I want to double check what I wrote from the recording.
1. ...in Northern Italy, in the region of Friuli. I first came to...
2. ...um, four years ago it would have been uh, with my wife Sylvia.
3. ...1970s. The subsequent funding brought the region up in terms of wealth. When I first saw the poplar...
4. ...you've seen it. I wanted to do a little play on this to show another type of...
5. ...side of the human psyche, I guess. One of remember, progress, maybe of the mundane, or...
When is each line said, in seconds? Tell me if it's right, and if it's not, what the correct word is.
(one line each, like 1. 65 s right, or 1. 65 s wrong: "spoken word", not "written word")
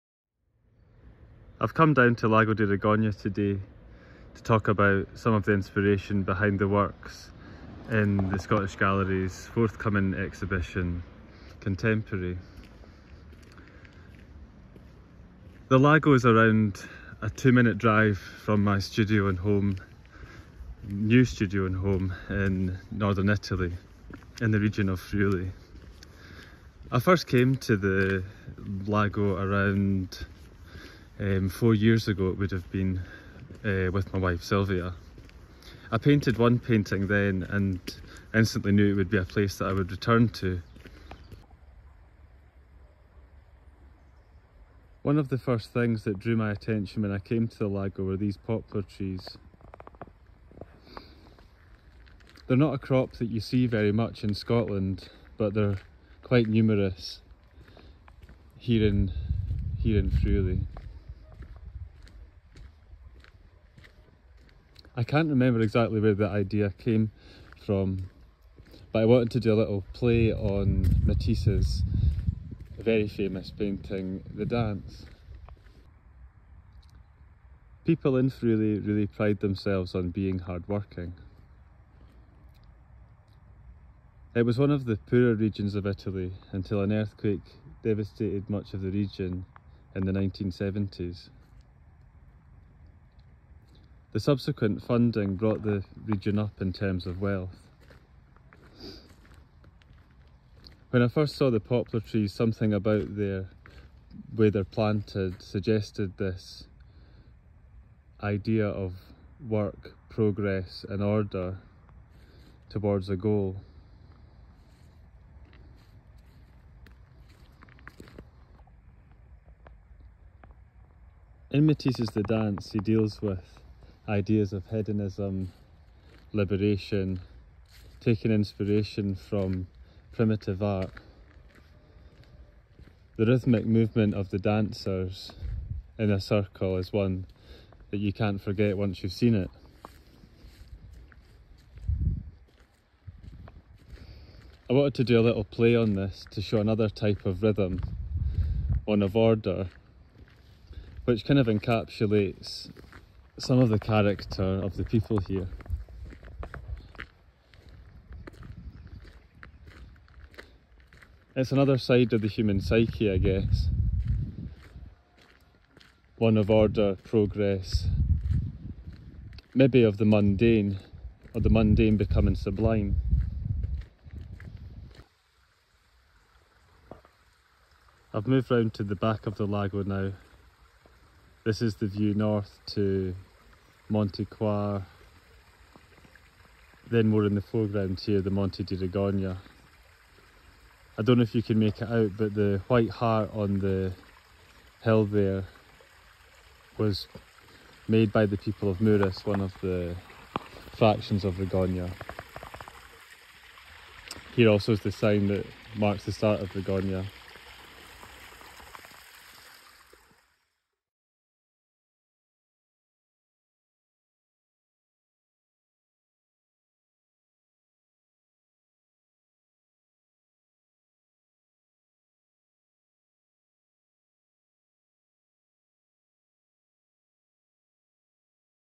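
1. 22 s right
2. 31 s right
3. 90 s right
4. 139 s right
5. 161 s wrong: "order", not "remember".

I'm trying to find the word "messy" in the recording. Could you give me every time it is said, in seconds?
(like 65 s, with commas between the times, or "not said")
not said.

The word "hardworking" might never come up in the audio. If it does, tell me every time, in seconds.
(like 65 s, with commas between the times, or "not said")
80 s.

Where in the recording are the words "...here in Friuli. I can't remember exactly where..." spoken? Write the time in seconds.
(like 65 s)
59 s.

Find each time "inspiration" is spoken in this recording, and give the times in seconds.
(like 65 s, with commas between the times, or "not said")
5 s, 128 s.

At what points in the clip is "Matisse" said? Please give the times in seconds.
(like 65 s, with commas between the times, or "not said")
71 s, 121 s.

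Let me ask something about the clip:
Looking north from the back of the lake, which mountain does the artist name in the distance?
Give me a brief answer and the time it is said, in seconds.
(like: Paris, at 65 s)
Monte Cuar, at 183 s.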